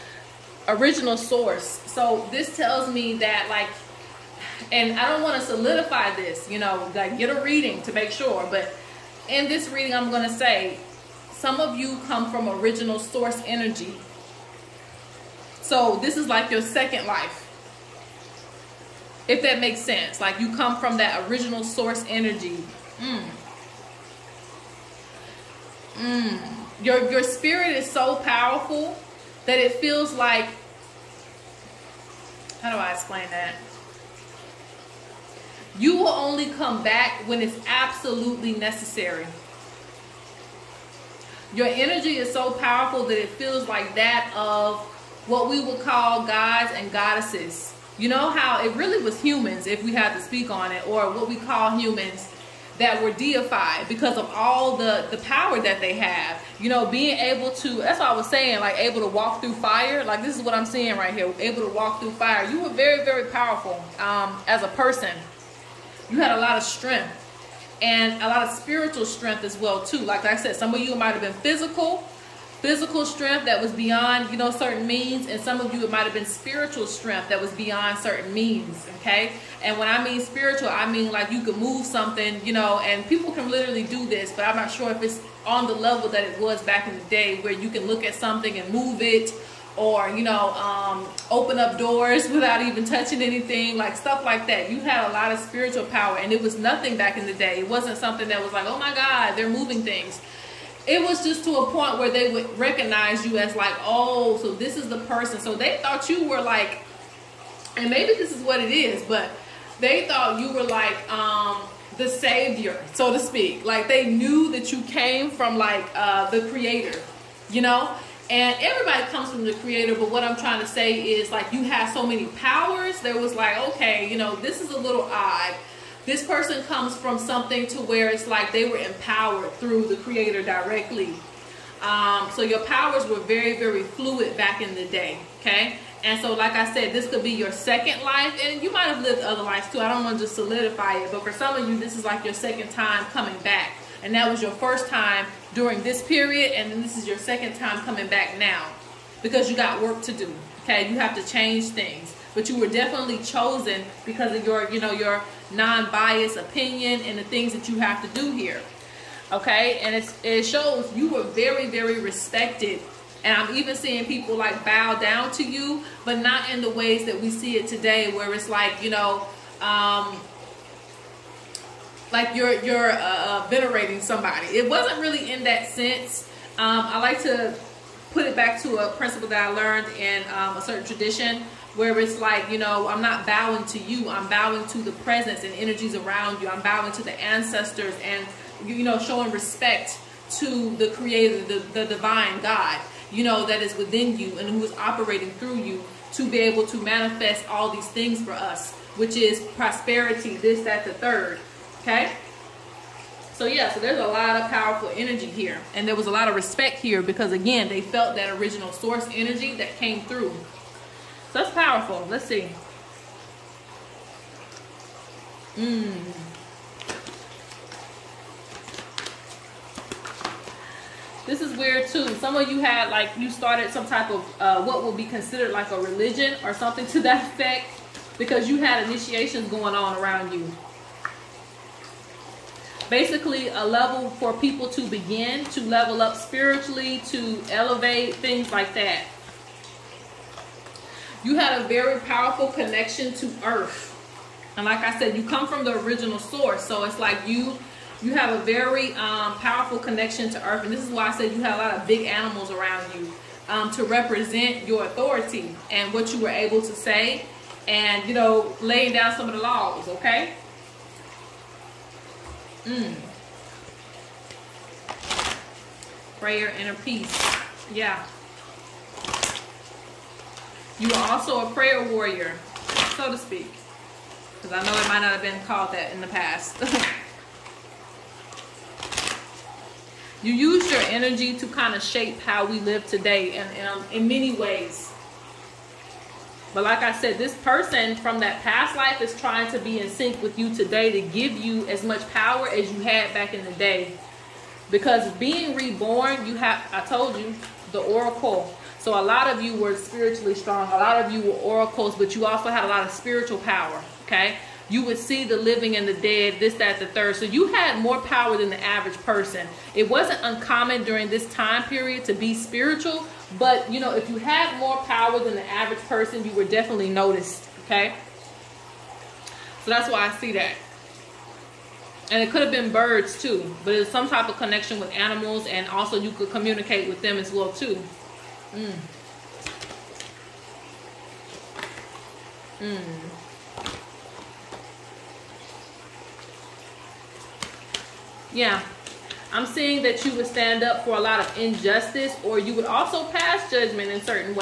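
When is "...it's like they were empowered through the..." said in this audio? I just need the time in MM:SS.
02:08.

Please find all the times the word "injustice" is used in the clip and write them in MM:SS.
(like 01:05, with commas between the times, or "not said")
05:41.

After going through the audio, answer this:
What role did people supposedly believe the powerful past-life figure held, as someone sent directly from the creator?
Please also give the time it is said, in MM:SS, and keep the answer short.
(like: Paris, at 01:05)
the savior, at 01:51.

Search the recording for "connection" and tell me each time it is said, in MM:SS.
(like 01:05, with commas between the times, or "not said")
04:02, 04:09, 05:24.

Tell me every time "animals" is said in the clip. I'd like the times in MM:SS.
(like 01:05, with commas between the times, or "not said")
04:12, 05:24.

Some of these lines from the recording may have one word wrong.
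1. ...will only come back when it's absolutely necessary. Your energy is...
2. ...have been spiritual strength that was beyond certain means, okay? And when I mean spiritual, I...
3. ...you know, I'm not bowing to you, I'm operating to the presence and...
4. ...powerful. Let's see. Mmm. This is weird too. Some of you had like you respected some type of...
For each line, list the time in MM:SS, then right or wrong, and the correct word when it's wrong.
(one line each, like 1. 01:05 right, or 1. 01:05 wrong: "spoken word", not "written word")
1. 00:35 right
2. 01:16 right
3. 03:02 wrong: "bowing", not "operating"
4. 03:31 wrong: "started", not "respected".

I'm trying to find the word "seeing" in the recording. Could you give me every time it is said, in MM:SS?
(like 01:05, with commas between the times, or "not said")
01:00, 02:43, 05:39.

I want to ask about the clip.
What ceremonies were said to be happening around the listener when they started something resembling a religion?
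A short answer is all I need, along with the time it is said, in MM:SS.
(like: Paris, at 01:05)
initiations, at 03:48.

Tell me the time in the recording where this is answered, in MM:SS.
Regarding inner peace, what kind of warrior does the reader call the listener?
04:31.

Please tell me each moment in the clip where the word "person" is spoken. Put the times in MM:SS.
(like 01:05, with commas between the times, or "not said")
01:04, 01:45, 02:06, 04:47, 05:09, 05:15.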